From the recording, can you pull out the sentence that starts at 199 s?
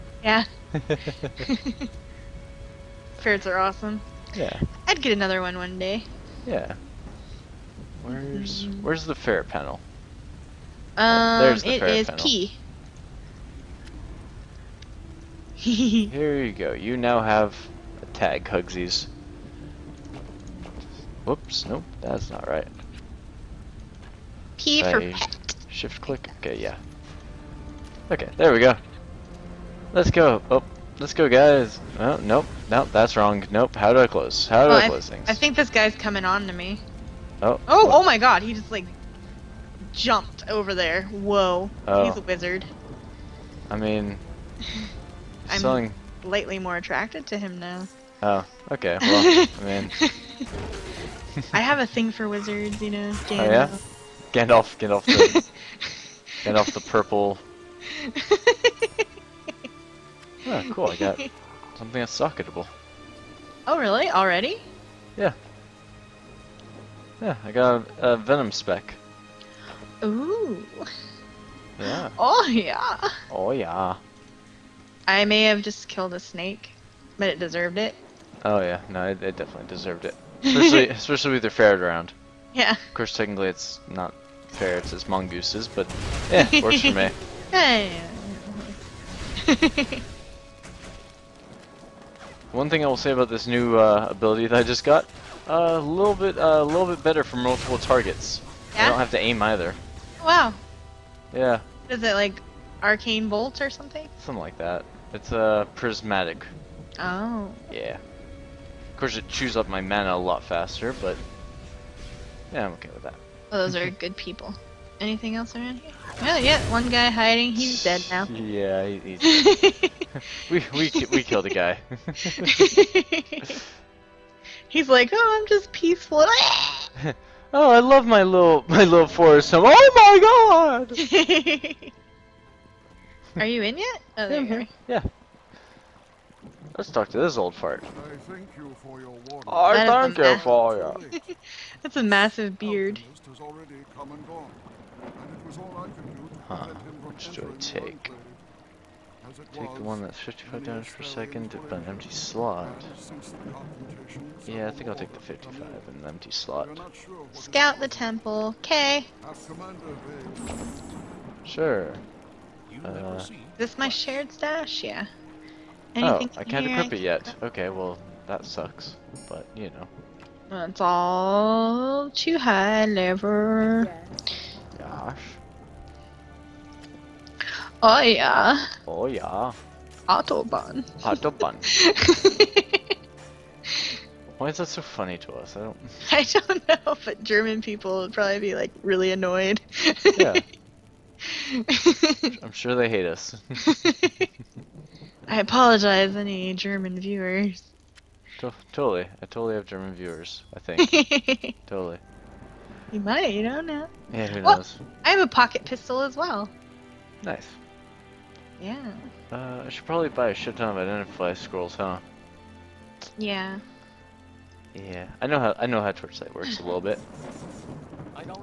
I totally have German viewers, I think.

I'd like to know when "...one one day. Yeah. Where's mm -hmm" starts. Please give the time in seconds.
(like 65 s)
5 s.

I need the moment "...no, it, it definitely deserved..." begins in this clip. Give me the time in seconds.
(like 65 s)
78 s.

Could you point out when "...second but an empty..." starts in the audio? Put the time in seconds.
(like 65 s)
151 s.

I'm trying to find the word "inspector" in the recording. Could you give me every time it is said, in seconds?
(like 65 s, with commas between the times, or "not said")
not said.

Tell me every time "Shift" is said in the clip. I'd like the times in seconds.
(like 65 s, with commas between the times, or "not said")
25 s.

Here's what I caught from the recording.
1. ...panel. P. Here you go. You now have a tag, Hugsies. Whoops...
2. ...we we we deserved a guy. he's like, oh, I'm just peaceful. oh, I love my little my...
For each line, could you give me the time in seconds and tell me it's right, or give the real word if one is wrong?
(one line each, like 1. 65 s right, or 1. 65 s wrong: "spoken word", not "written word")
1. 12 s right
2. 120 s wrong: "killed", not "deserved".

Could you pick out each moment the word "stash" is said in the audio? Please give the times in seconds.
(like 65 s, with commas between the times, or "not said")
164 s.